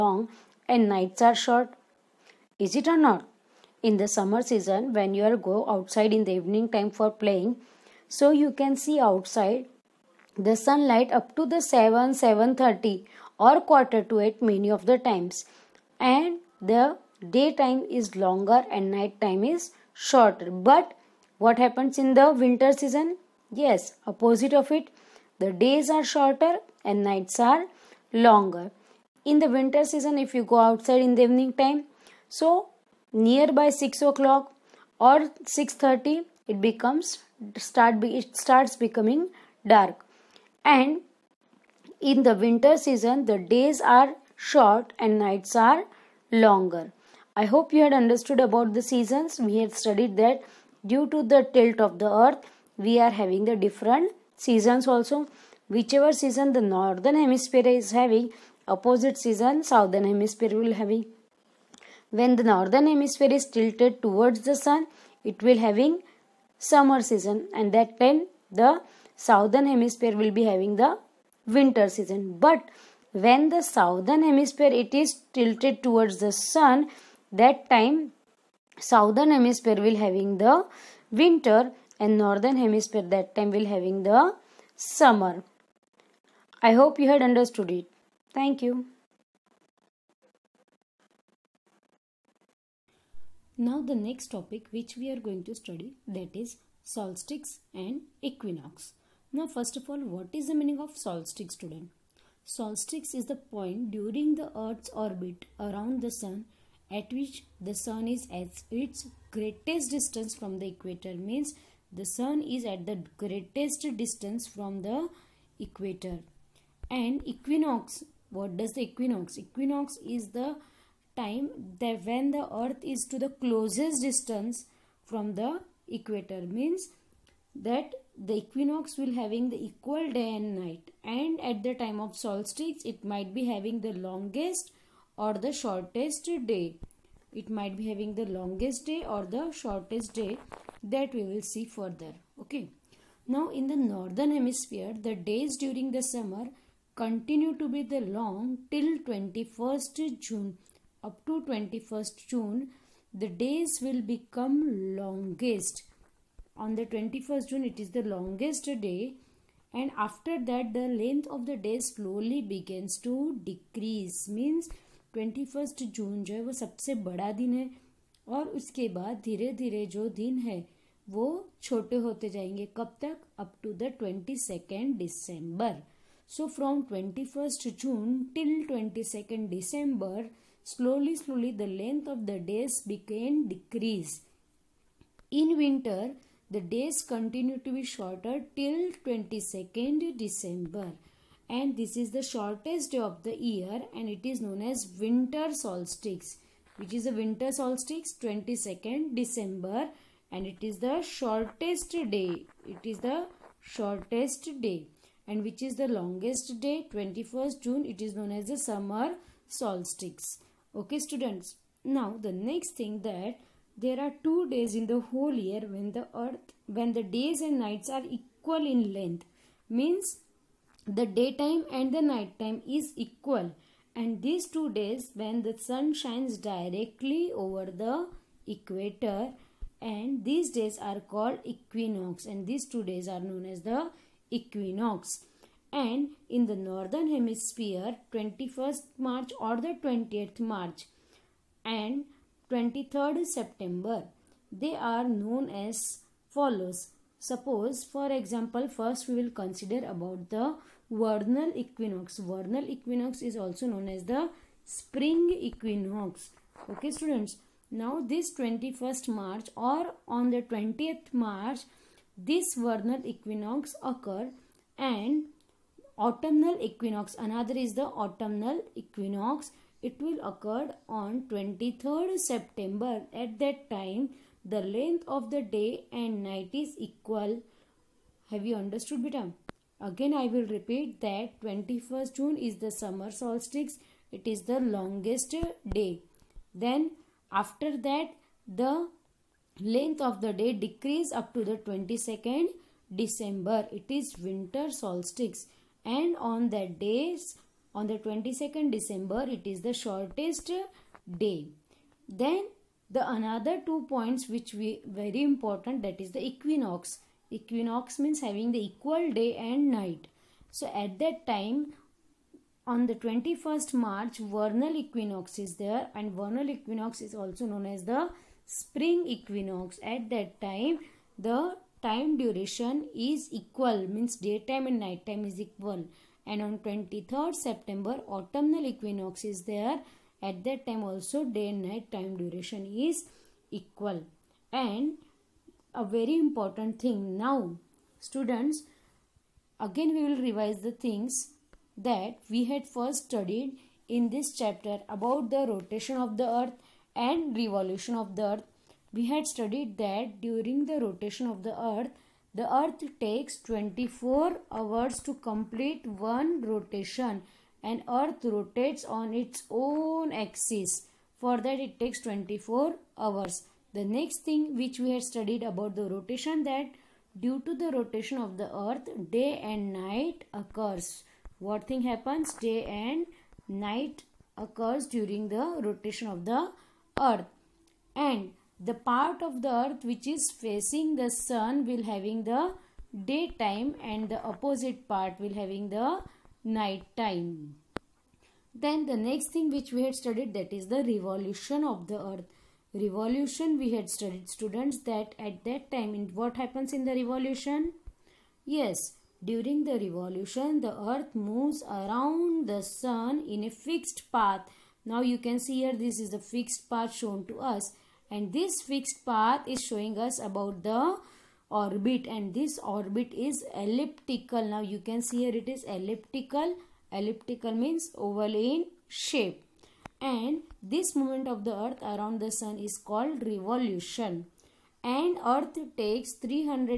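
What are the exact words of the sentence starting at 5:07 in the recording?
Equinox means having the equal day and night.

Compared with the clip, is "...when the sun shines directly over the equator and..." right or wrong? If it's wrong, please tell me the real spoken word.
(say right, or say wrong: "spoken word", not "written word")
right.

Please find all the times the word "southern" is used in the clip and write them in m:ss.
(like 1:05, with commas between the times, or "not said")
0:59, 1:09, 1:13, 1:18.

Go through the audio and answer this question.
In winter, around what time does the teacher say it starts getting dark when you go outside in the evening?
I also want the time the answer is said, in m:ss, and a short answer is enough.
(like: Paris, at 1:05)
6:30, at 0:35.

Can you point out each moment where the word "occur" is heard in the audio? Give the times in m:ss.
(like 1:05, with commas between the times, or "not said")
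4:23, 4:30, 6:10, 6:14.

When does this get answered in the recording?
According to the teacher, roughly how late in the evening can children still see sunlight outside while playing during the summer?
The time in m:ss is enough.
0:13.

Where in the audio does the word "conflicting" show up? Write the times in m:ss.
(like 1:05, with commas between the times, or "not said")
not said.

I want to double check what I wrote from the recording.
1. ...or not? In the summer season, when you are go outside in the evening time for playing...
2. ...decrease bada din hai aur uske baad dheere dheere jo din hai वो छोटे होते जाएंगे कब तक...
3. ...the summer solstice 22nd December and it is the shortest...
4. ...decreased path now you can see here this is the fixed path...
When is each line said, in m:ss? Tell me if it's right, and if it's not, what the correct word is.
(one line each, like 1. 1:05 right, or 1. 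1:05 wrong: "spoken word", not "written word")
1. 0:02 right
2. 2:46 wrong: "sabse", not "decrease"
3. 3:17 wrong: "winter", not "summer"
4. 6:43 wrong: "fixed", not "decreased".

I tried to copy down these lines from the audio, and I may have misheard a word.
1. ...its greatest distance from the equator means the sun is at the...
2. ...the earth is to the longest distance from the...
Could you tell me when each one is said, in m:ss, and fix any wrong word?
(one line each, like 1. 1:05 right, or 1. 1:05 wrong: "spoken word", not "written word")
1. 1:48 right
2. 2:02 wrong: "closest", not "longest".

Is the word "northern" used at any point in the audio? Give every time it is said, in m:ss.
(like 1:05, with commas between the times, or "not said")
0:56, 1:02, 1:22, 2:23, 3:56.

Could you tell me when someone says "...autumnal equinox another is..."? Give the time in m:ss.
4:25.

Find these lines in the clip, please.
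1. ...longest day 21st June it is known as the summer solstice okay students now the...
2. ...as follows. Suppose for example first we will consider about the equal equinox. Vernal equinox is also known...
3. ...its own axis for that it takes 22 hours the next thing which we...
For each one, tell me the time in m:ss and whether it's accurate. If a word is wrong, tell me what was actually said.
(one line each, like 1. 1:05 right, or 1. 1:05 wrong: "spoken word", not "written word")
1. 3:25 right
2. 4:05 wrong: "vernal", not "equal"
3. 5:59 wrong: "24", not "22".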